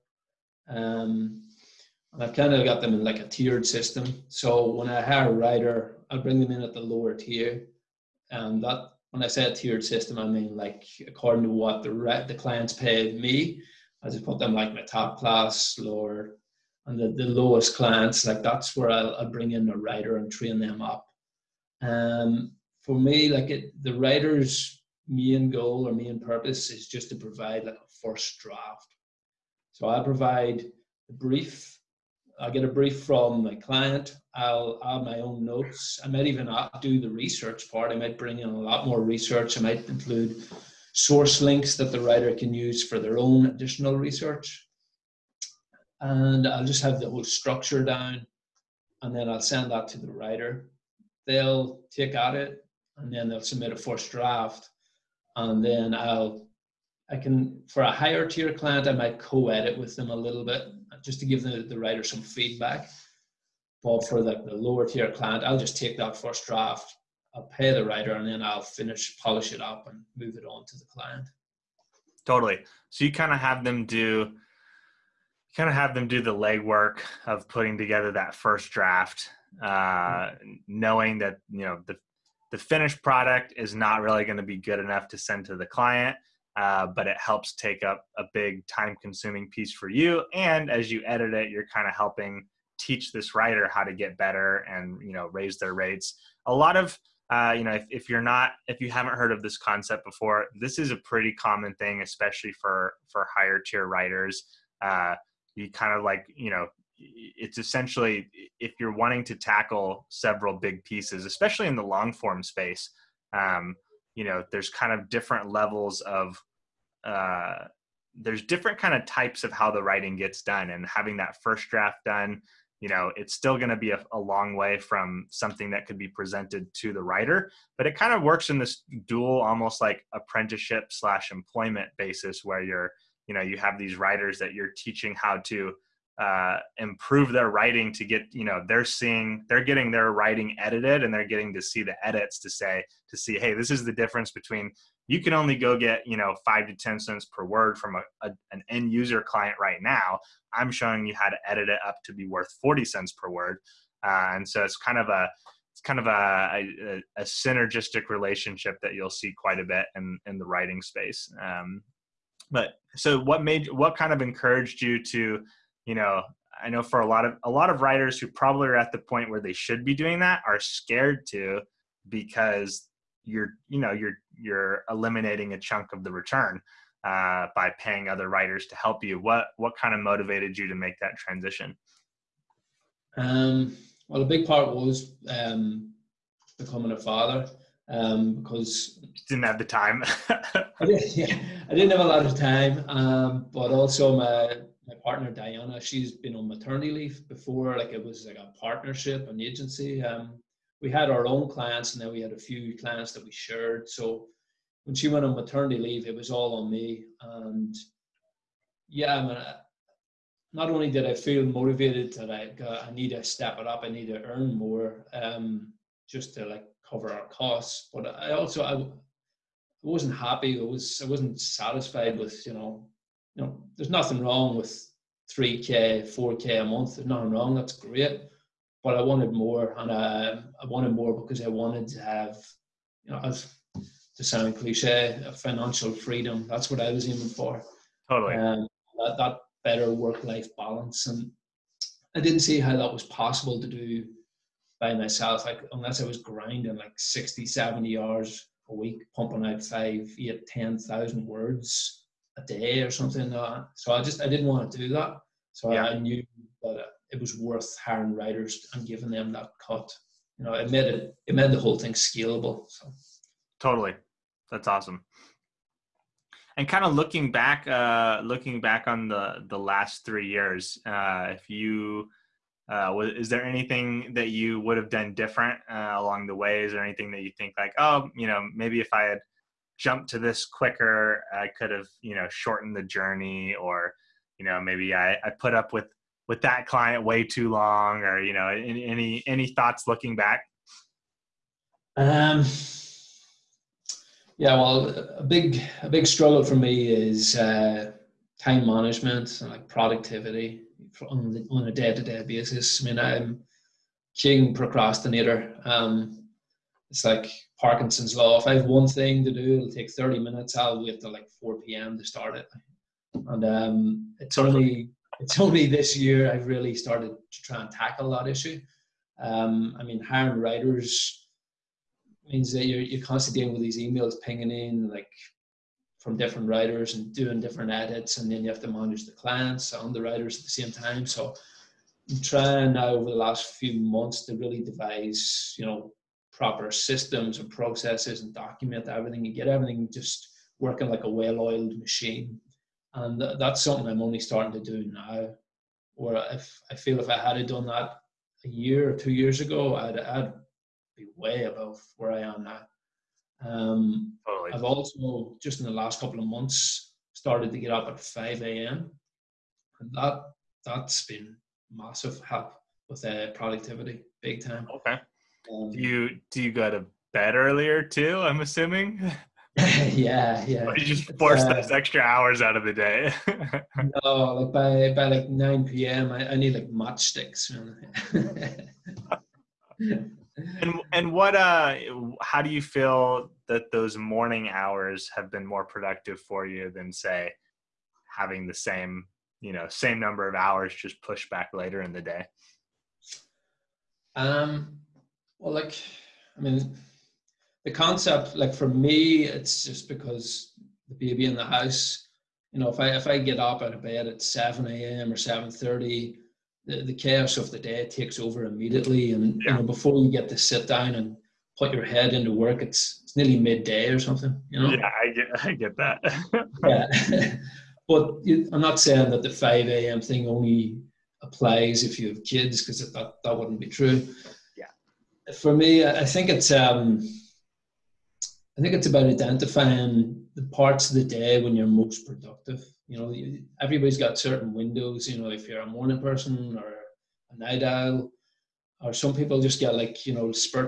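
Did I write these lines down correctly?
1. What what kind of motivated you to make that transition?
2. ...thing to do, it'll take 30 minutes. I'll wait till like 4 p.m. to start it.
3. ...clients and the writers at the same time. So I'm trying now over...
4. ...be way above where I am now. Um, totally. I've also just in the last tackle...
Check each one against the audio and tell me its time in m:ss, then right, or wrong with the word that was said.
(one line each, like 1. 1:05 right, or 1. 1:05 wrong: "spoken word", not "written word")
1. 2:59 right
2. 5:08 right
3. 5:29 right
4. 5:50 wrong: "couple", not "tackle".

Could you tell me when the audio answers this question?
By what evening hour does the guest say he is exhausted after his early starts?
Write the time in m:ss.
6:15.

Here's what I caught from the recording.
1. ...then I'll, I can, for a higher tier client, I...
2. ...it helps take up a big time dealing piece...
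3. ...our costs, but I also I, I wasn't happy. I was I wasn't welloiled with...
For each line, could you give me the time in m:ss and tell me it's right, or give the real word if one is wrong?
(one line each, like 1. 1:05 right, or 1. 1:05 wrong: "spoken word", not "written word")
1. 0:55 right
2. 1:27 wrong: "consuming", not "dealing"
3. 3:37 wrong: "satisfied", not "welloiled".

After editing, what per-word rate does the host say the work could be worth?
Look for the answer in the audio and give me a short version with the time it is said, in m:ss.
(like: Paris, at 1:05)
40 cents per word, at 2:32.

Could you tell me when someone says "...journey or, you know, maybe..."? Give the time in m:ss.
4:42.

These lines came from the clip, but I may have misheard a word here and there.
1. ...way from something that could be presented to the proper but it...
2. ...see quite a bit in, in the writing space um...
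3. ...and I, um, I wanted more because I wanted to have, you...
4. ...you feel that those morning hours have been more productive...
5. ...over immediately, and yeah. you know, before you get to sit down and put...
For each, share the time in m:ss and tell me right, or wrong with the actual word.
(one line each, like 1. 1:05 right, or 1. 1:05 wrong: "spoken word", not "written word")
1. 2:04 wrong: "writer", not "proper"
2. 2:39 right
3. 3:49 right
4. 6:22 right
5. 6:48 right.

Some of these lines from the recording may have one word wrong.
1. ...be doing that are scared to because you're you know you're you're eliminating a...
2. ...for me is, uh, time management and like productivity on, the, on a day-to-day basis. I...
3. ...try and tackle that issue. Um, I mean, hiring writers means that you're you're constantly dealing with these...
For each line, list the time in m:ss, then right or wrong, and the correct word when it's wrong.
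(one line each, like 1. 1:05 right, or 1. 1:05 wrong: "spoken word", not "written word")
1. 2:49 right
2. 4:56 right
3. 5:17 right.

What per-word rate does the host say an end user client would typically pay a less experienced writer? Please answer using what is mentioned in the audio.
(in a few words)
5 to 10 cents per word.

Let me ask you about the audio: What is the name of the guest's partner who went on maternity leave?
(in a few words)
Diana.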